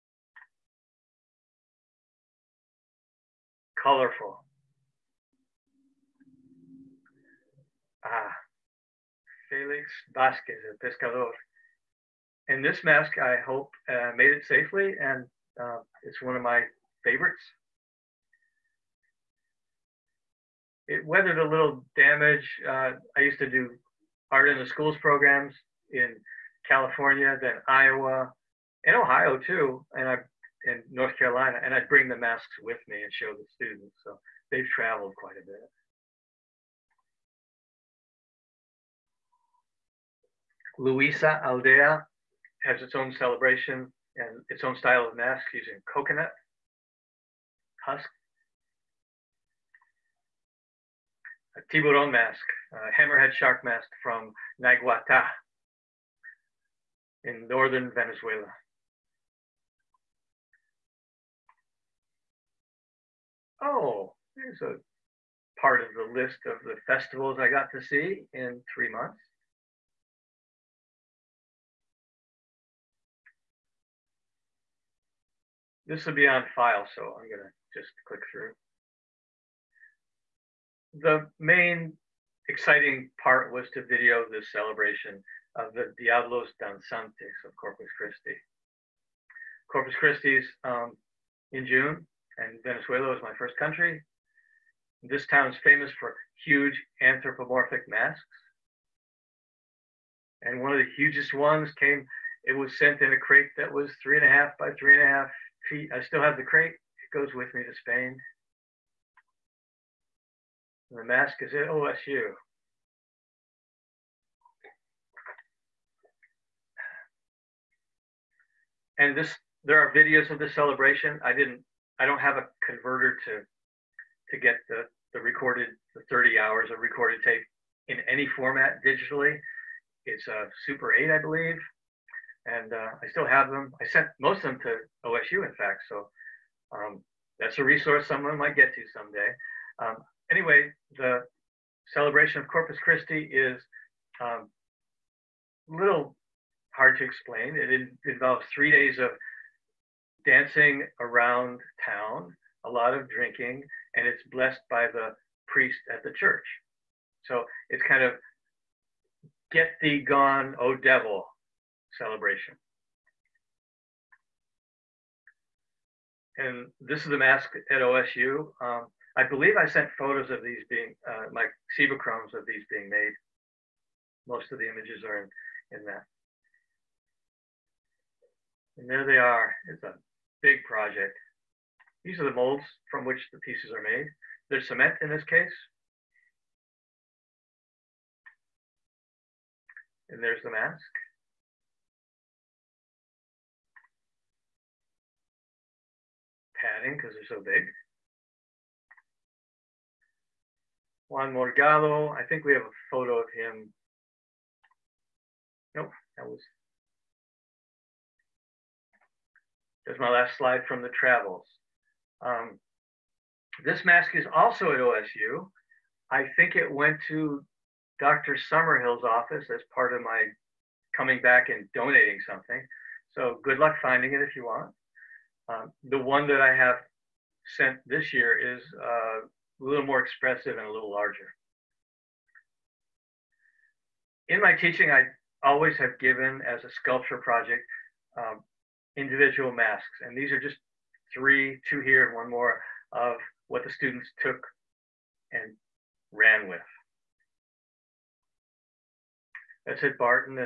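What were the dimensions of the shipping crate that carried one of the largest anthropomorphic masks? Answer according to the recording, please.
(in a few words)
3.5 by 3.5 feet.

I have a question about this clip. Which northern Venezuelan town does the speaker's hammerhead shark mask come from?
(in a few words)
Naiguatá.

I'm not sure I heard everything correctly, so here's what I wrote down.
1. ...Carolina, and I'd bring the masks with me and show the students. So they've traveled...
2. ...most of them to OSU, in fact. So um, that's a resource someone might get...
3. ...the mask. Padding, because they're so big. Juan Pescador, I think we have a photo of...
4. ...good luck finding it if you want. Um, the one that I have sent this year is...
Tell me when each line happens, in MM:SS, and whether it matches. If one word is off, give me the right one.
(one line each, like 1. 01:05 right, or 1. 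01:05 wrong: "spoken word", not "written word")
1. 00:31 right
2. 02:14 right
3. 03:10 wrong: "Morgado", not "Pescador"
4. 03:43 right.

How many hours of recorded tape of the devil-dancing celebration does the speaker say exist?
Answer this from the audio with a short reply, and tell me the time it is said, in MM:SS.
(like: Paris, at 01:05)
30 hours, at 02:06.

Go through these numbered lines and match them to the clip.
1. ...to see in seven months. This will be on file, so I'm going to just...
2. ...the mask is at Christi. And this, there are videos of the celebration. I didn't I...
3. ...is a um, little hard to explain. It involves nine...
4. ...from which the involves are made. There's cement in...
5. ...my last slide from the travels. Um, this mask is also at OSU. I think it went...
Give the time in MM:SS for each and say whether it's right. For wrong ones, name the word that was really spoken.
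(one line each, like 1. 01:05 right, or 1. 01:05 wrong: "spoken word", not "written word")
1. 01:07 wrong: "three", not "seven"
2. 01:50 wrong: "OSU", not "Christi"
3. 02:23 wrong: "three", not "nine"
4. 03:02 wrong: "pieces", not "involves"
5. 03:29 right.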